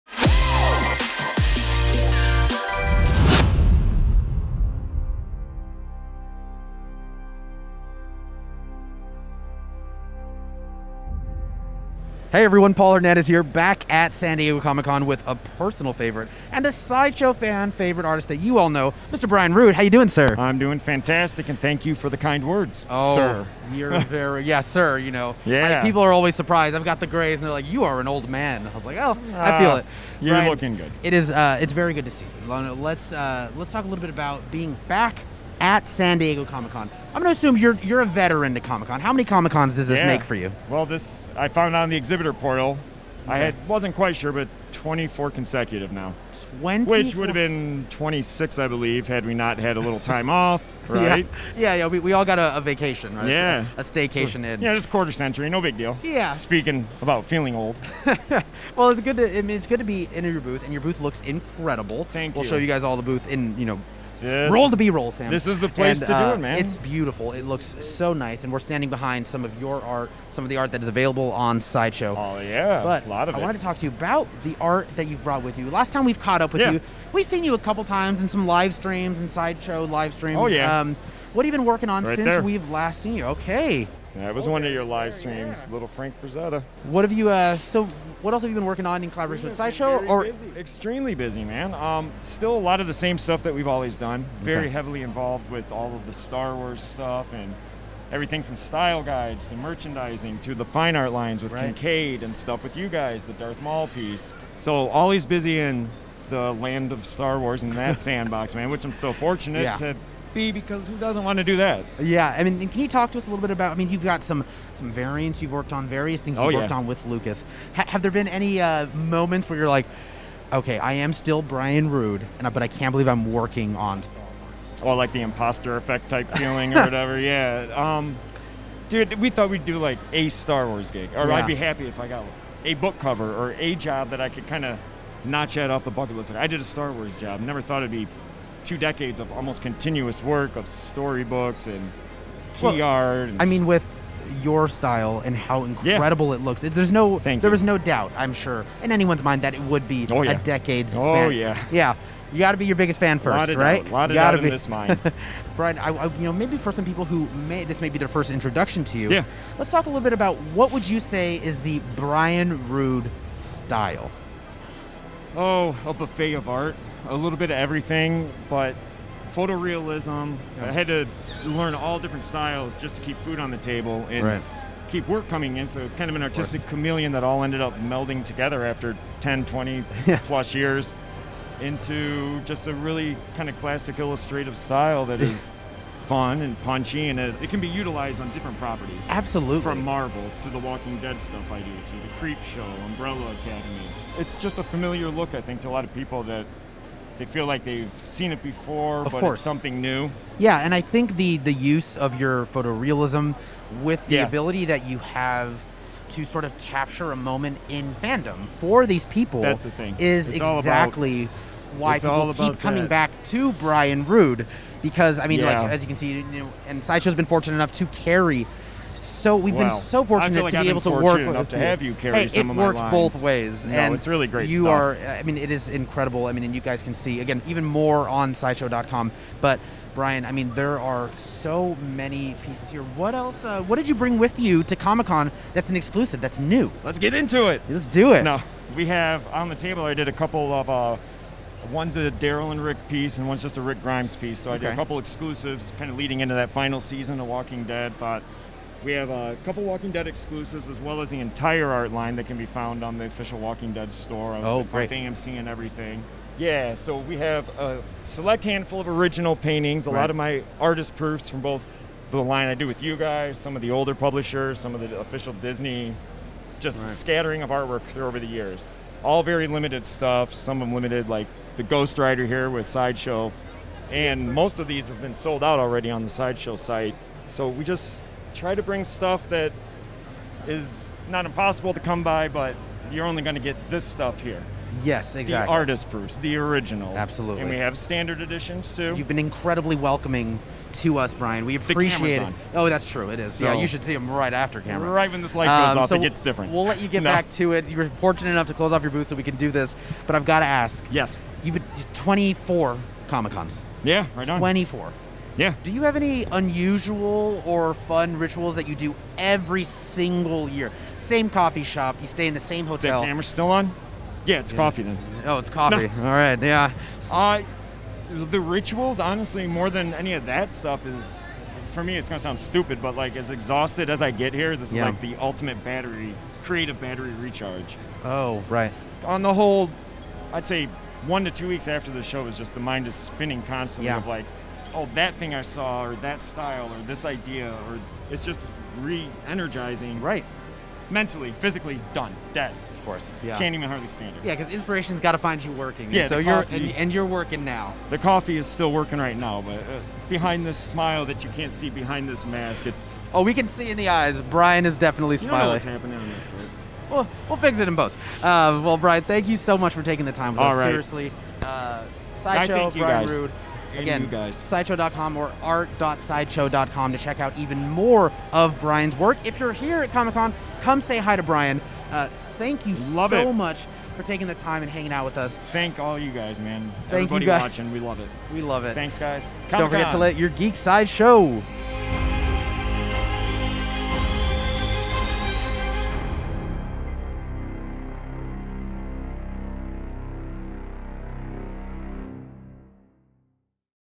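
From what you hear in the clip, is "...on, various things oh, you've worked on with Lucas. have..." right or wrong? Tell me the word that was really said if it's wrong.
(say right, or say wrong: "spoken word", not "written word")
right.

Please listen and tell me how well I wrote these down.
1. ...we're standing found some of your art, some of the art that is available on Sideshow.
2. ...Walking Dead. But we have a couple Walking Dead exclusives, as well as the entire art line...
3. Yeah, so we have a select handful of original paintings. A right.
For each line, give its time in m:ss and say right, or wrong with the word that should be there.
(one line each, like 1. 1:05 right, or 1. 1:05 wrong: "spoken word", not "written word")
1. 1:08 wrong: "behind", not "found"
2. 4:07 right
3. 4:16 right.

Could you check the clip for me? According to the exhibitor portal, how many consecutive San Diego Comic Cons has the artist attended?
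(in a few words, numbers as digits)
24.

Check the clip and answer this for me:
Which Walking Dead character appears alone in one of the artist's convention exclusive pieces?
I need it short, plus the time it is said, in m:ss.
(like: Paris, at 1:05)
Rick Grimes, at 4:03.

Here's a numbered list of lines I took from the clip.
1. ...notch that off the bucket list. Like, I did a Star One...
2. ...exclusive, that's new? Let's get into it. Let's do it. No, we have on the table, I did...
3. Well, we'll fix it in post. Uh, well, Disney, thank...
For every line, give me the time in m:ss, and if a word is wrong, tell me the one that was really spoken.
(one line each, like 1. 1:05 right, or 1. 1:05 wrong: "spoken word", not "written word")
1. 2:15 wrong: "Wars", not "One"
2. 3:55 right
3. 5:56 wrong: "Brian", not "Disney".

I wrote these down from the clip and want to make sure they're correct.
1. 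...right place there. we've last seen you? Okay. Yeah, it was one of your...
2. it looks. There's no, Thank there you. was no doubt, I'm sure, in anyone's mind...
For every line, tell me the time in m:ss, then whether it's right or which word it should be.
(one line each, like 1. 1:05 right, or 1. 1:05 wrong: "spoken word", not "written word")
1. 1:22 wrong: "since", not "place"
2. 2:26 right.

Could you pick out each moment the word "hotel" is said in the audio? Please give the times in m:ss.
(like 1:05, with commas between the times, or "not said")
5:12.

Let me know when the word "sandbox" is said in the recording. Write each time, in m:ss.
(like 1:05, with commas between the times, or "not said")
1:47.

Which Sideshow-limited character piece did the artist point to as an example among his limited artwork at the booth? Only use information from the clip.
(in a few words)
Ghost Rider.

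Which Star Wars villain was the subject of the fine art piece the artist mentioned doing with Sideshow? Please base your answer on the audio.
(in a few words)
Darth Maul.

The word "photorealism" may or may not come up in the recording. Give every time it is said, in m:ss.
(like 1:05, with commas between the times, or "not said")
2:49, 3:22.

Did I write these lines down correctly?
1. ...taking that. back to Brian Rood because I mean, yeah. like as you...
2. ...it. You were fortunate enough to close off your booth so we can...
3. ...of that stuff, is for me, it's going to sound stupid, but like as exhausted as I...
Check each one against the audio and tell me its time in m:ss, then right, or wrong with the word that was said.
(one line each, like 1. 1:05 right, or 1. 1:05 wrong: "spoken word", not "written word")
1. 3:32 wrong: "coming", not "taking"
2. 4:57 right
3. 5:20 right.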